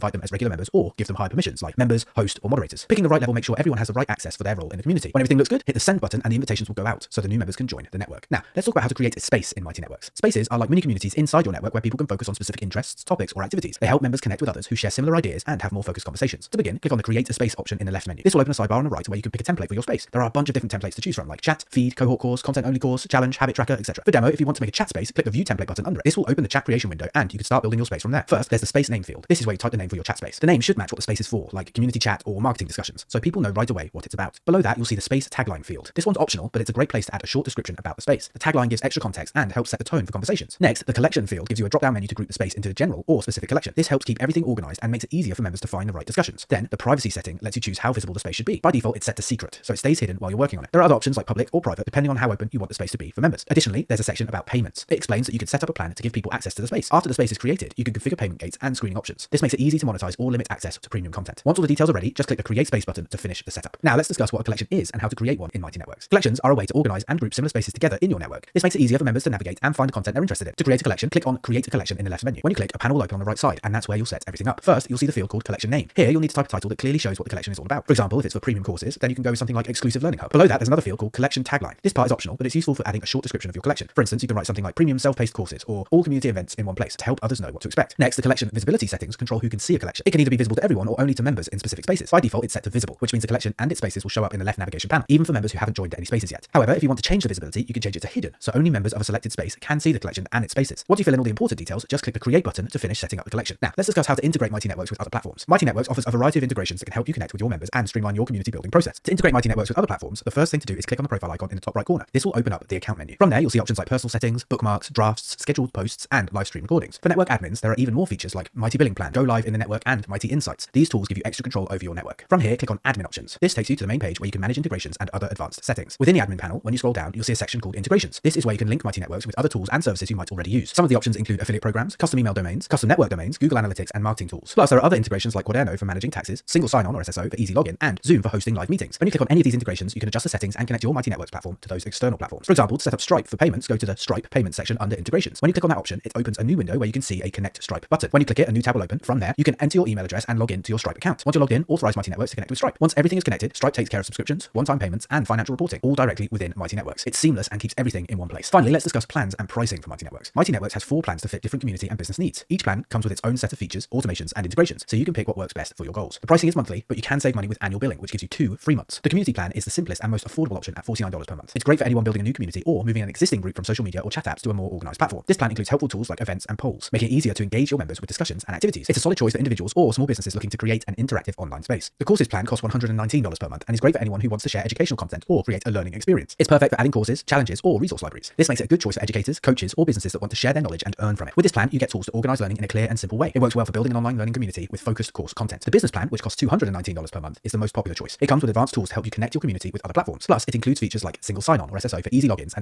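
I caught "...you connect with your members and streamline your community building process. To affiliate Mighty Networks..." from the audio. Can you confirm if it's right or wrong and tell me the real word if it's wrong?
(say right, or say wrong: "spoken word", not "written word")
wrong: "integrate", not "affiliate".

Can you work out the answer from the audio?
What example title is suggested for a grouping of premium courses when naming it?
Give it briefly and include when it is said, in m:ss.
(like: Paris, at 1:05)
Exclusive Learning Hub, at 1:19.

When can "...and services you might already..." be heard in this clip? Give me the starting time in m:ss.
2:09.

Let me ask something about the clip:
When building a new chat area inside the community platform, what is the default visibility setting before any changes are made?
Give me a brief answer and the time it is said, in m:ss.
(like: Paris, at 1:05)
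Secret, at 0:49.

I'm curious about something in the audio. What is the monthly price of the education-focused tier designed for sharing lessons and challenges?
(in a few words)
$119.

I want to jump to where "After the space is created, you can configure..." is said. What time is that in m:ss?
0:56.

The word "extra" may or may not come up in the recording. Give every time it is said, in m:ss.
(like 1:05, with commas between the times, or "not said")
0:38, 2:01.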